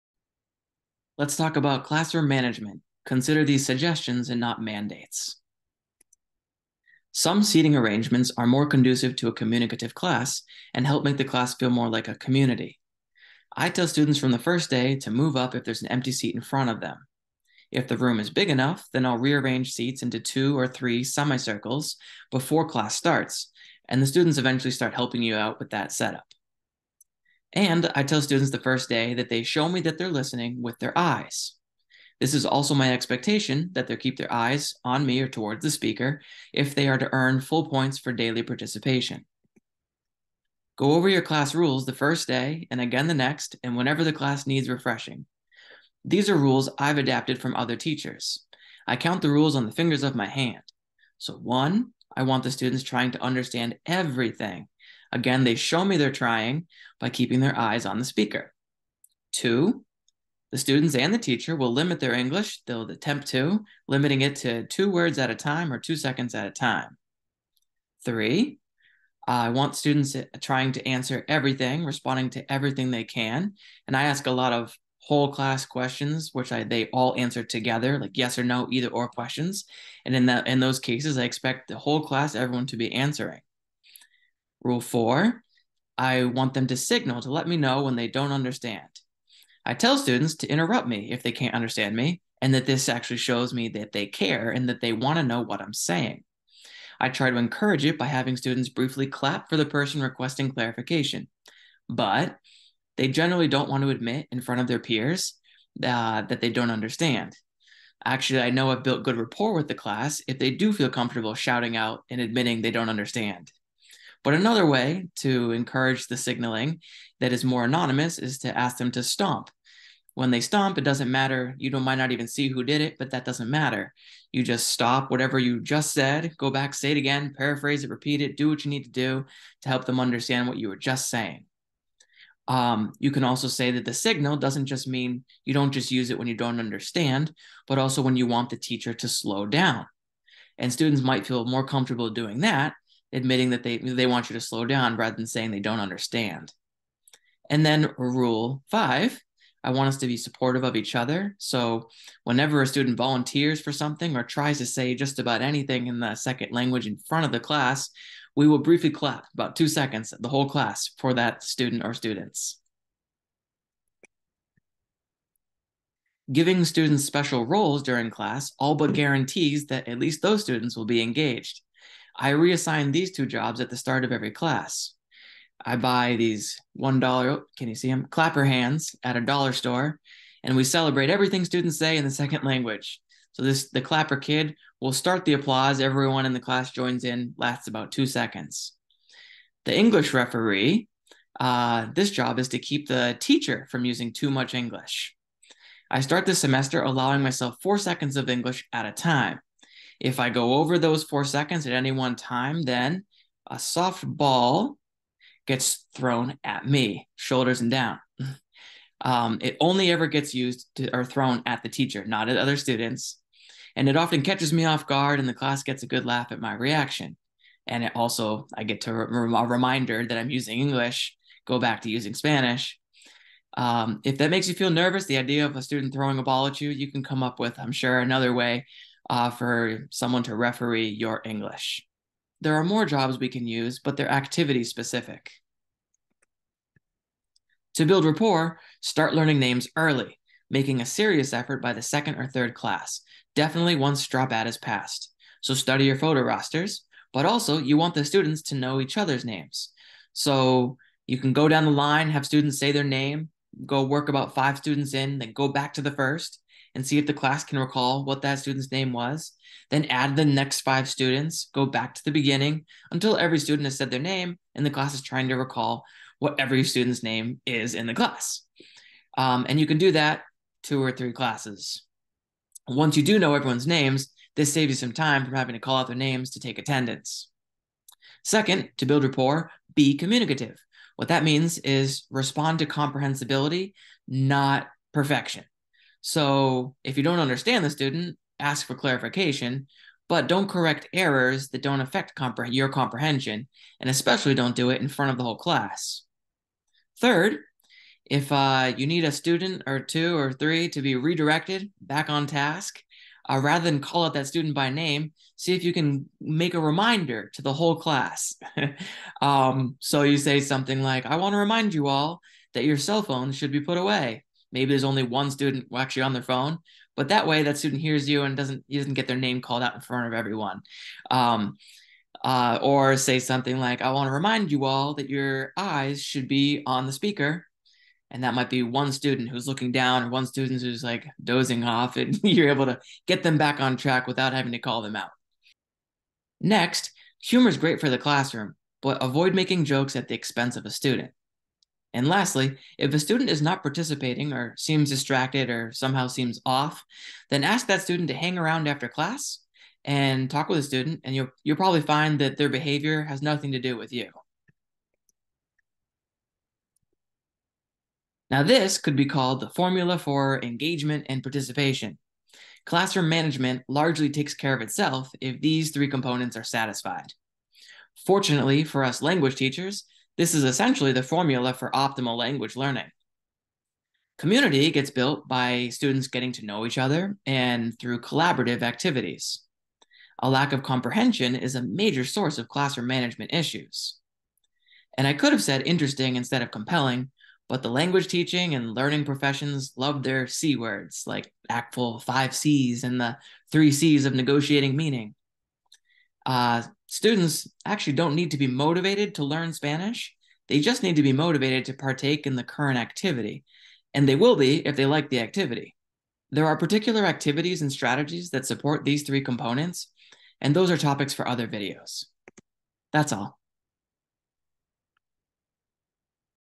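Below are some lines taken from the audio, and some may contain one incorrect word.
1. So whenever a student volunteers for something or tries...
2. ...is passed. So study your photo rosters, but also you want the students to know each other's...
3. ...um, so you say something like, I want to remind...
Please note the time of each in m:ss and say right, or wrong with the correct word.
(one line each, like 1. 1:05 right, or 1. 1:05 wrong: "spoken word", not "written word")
1. 2:31 right
2. 4:04 right
3. 5:09 right.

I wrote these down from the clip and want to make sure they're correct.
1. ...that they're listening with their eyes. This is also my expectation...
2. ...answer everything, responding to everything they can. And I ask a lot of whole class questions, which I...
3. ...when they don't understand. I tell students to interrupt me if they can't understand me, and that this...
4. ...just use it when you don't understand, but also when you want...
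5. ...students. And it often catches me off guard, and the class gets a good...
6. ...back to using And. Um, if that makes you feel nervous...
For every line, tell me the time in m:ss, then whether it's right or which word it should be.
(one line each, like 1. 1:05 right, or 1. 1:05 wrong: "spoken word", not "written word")
1. 0:29 right
2. 1:10 right
3. 1:27 right
4. 2:15 right
5. 3:32 right
6. 3:41 wrong: "Spanish", not "And".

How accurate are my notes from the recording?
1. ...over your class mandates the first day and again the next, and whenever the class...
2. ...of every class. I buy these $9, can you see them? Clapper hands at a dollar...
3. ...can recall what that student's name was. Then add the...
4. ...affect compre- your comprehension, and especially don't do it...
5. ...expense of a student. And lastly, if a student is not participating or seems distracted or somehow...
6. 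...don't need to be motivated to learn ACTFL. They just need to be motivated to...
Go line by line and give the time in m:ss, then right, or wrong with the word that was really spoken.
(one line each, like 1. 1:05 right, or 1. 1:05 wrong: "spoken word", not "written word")
1. 0:40 wrong: "rules", not "mandates"
2. 2:54 wrong: "1", not "9"
3. 4:17 right
4. 4:51 right
5. 5:40 right
6. 6:37 wrong: "Spanish", not "ACTFL".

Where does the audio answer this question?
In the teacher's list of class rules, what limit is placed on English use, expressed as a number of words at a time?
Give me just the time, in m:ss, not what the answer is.
1:04.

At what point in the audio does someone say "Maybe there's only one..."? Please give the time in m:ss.
5:14.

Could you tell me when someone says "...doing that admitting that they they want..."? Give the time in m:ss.
2:22.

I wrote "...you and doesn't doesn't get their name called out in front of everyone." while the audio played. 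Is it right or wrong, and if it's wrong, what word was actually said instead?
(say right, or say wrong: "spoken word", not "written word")
right.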